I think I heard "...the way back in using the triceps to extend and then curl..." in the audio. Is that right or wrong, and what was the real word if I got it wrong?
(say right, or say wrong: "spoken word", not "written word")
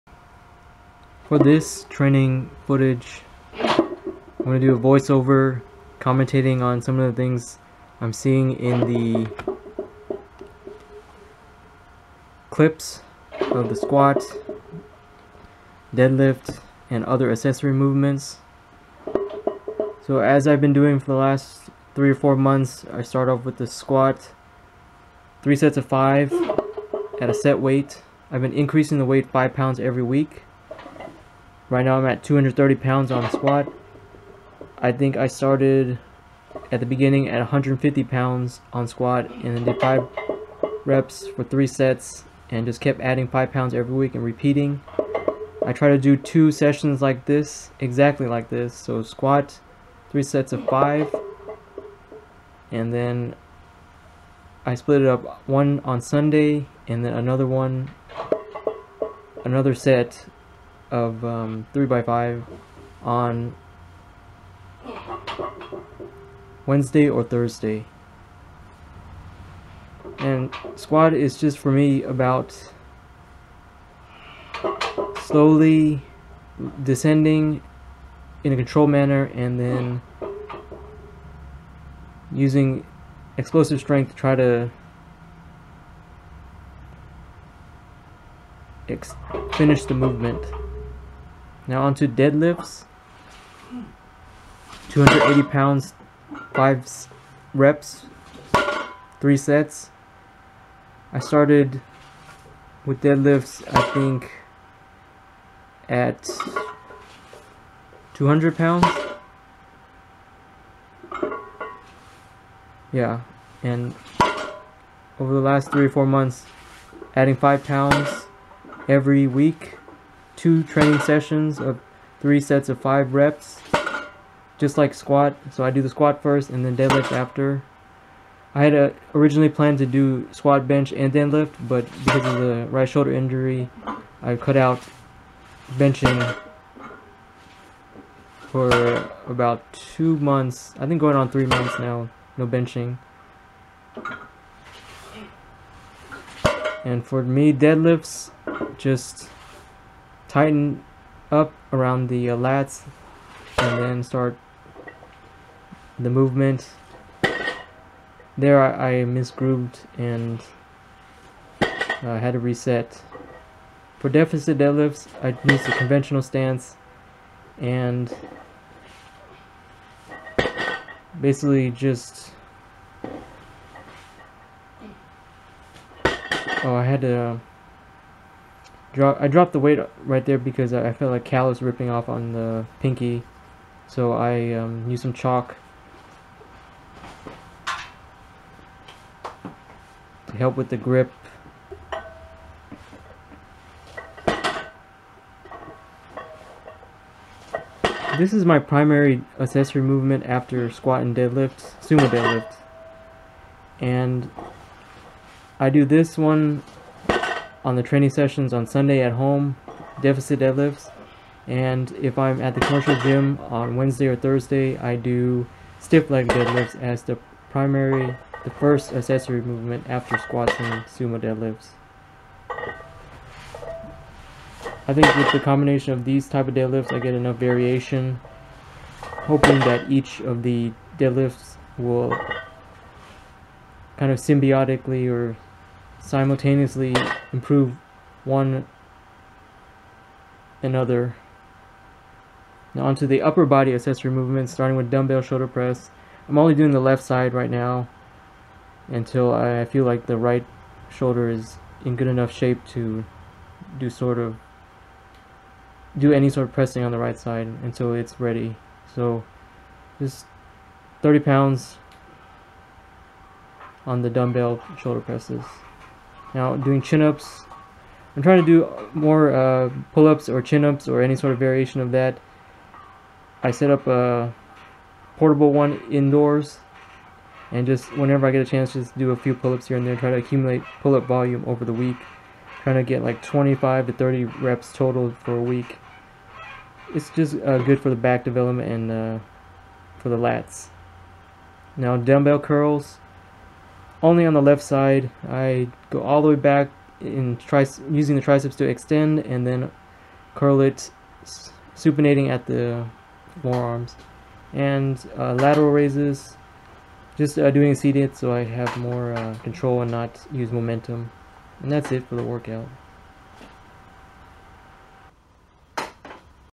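right.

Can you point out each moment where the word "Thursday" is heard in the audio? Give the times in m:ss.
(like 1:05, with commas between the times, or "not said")
1:07, 3:34.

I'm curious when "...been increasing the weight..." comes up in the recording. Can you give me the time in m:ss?
0:28.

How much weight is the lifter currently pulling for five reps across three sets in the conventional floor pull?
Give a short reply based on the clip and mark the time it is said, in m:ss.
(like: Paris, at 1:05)
280 pounds, at 1:34.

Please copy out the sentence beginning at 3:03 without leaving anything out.
So I um, used some chalk to help with the grip.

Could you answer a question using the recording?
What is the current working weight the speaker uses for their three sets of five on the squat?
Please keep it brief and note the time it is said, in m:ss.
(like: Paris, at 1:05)
230 pounds, at 0:32.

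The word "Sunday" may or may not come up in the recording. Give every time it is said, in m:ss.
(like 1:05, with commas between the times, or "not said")
0:56, 3:28.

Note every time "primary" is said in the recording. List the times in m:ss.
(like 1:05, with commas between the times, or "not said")
3:18, 3:37.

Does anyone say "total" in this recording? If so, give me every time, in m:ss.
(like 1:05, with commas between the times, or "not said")
4:44.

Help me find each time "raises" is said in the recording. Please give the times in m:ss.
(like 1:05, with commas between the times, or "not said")
5:05.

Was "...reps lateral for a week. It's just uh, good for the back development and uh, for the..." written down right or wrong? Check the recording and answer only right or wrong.
wrong.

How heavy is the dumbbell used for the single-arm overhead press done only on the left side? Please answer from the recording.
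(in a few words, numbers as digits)
30 pounds.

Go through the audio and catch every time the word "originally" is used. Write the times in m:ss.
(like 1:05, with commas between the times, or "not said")
2:09.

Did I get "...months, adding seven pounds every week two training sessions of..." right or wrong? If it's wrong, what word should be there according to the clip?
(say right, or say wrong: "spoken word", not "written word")
wrong: "five", not "seven".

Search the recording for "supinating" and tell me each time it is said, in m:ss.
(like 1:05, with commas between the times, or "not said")
5:01.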